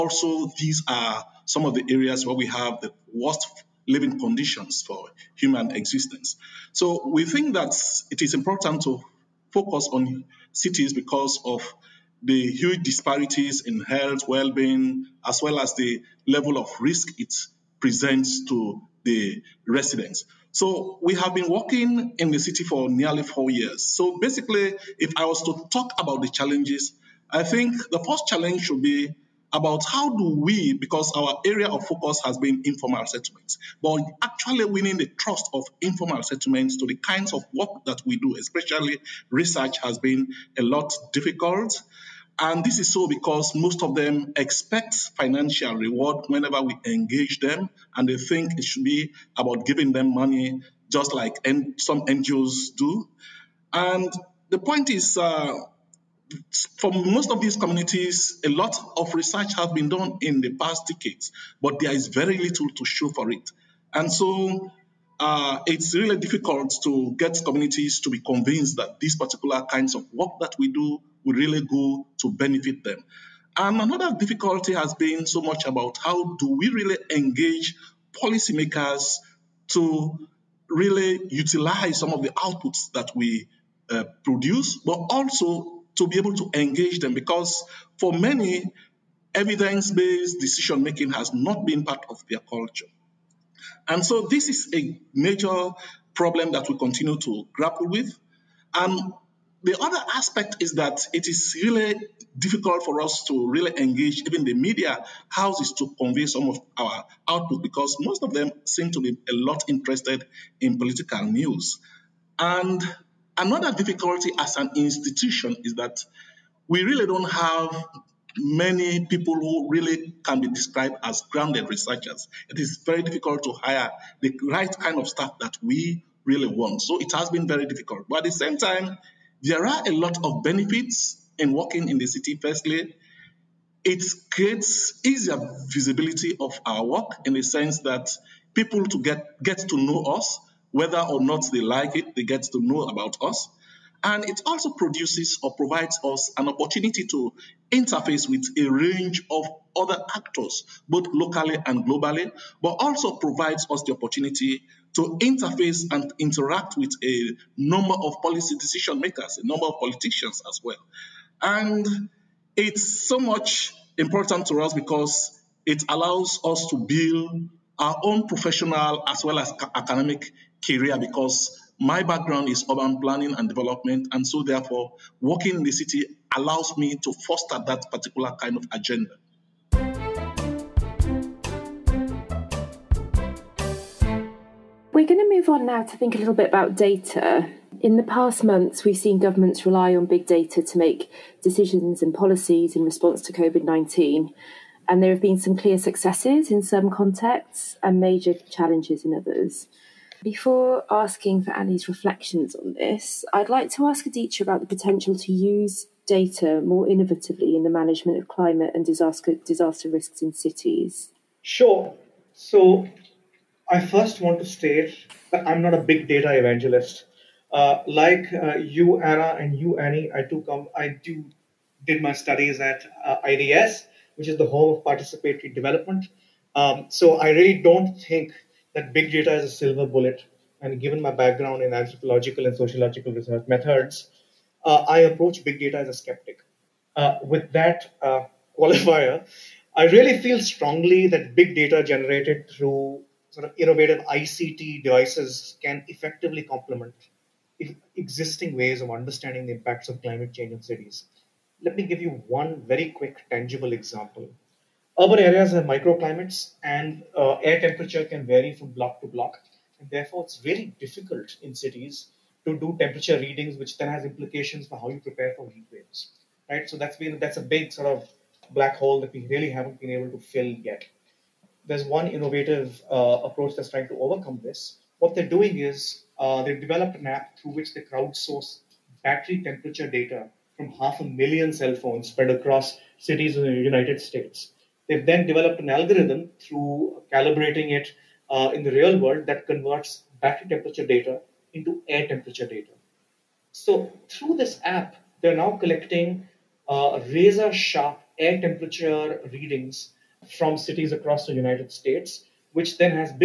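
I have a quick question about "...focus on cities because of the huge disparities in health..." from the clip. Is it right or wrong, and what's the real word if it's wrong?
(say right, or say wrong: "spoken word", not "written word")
right.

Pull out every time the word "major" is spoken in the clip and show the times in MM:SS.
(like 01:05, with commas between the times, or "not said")
01:35, 03:18.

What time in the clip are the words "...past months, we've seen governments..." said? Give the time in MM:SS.
03:08.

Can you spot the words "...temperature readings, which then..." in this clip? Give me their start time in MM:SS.
04:22.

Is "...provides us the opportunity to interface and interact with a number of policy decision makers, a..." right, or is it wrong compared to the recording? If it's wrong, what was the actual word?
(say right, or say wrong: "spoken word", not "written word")
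right.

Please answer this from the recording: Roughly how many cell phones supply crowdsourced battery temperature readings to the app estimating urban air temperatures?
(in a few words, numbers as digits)
half a million.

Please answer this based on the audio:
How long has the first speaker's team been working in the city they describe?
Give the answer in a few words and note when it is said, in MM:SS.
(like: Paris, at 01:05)
nearly four years, at 00:22.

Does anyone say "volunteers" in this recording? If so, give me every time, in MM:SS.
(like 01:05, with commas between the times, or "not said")
not said.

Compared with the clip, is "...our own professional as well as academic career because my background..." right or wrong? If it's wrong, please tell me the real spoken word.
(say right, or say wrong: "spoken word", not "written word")
right.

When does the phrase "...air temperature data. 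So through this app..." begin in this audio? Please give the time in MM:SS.
04:51.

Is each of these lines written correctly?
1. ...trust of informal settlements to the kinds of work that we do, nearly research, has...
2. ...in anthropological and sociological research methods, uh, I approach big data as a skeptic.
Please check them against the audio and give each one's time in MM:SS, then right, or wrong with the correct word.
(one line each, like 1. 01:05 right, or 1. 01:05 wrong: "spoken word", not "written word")
1. 00:35 wrong: "especially", not "nearly"
2. 03:51 right.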